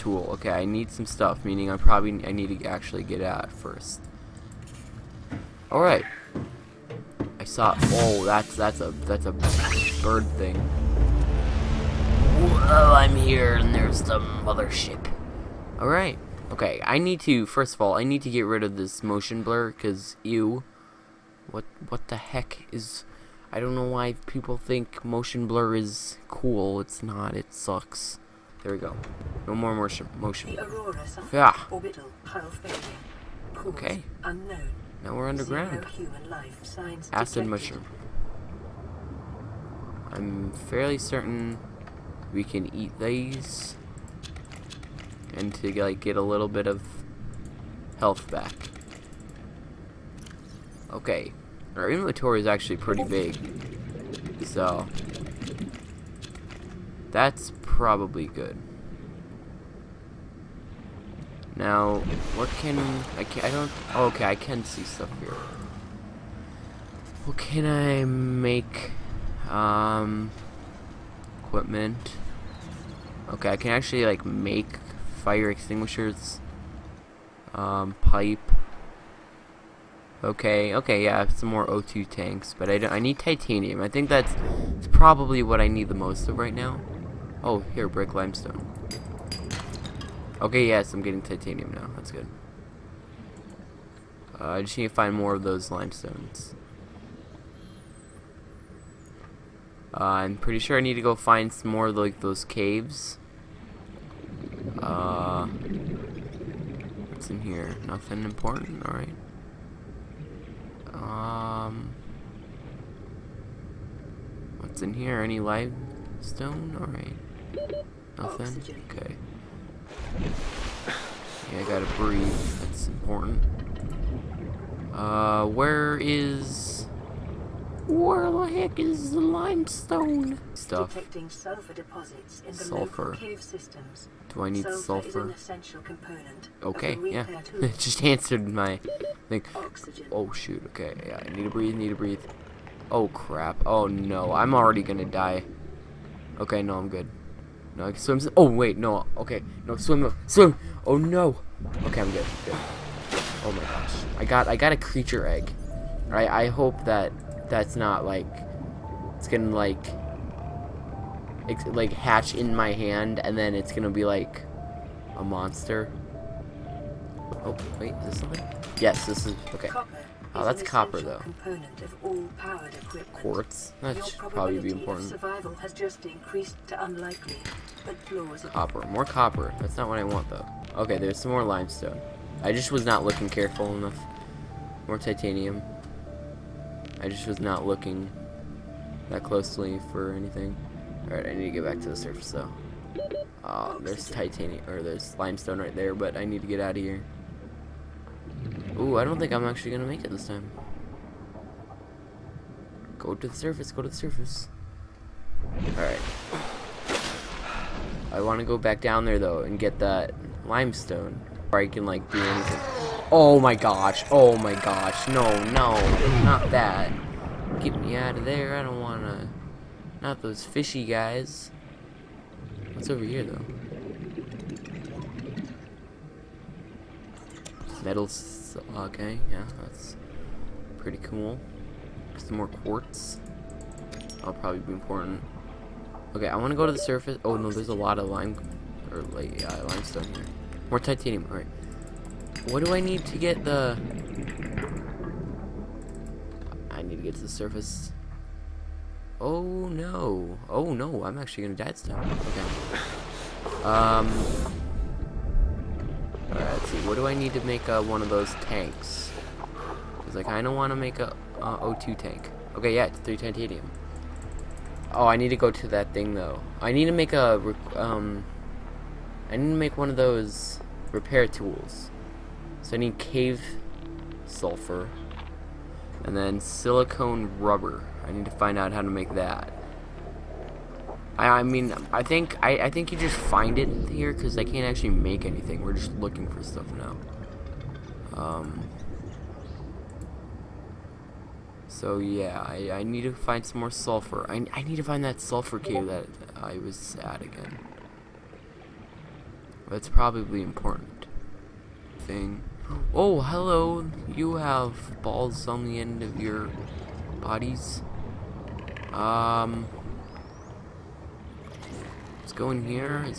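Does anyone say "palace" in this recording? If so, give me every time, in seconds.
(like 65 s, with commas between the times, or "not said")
not said.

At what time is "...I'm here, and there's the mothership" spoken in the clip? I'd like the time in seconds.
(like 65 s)
12 s.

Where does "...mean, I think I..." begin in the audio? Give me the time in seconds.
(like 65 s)
281 s.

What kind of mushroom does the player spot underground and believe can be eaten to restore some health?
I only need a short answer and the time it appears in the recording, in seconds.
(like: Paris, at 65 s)
Acid mushroom, at 37 s.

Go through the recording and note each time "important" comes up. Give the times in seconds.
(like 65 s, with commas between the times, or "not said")
108 s, 122 s, 174 s, 234 s, 300 s.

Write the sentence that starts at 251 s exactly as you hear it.
I'm actually going to die this time.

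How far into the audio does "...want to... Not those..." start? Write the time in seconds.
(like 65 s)
218 s.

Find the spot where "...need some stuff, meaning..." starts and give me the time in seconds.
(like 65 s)
0 s.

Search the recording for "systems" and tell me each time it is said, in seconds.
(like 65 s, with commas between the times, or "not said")
133 s.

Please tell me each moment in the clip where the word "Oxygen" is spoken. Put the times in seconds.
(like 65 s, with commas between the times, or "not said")
139 s.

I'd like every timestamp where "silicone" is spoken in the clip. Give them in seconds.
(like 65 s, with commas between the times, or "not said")
276 s.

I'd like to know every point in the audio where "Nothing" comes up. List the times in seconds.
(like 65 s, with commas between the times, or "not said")
107 s, 118 s.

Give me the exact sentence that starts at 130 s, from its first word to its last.
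Detecting sulfur deposits in the sulfur.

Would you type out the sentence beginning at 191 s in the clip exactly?
Alright, I need to get back to the surface though.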